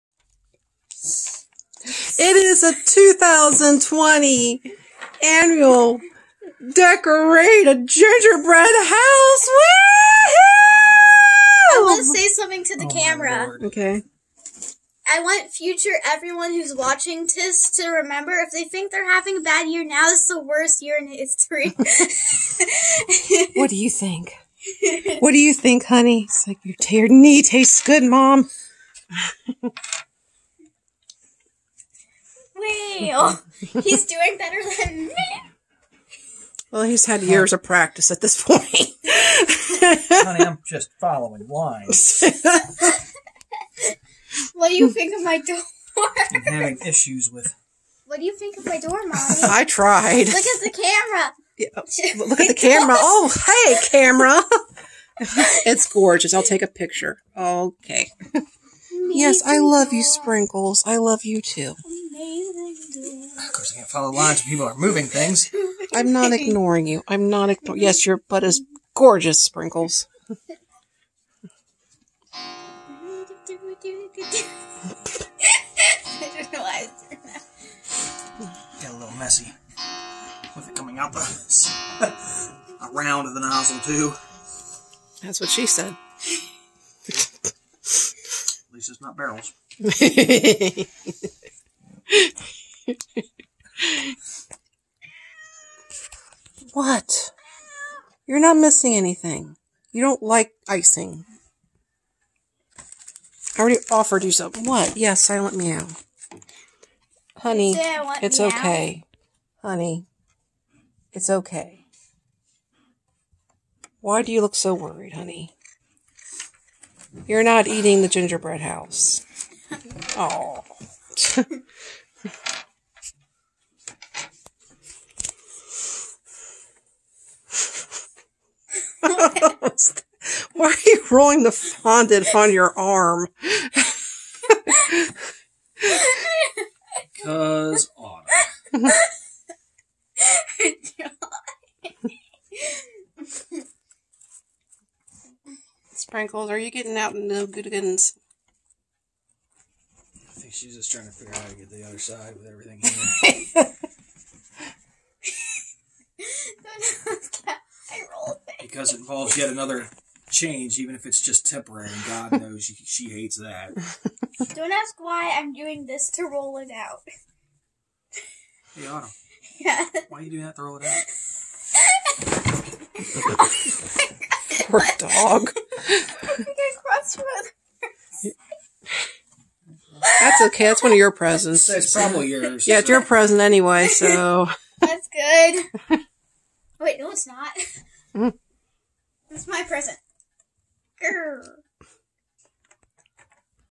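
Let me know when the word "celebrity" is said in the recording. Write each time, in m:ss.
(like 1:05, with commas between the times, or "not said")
not said.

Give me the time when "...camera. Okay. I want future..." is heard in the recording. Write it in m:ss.
0:12.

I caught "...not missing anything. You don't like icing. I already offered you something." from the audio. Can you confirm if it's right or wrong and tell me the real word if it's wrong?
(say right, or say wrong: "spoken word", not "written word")
right.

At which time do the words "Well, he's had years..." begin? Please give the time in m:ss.
0:36.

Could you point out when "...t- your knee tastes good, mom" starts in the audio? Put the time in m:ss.
0:26.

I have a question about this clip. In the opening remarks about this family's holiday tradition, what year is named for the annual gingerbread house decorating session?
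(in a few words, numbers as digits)
2020.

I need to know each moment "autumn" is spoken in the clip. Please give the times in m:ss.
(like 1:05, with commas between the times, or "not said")
2:17, 2:48.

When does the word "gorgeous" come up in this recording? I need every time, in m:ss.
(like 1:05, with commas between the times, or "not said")
0:55, 1:08.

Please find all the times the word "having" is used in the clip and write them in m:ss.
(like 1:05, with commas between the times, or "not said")
0:19, 0:46.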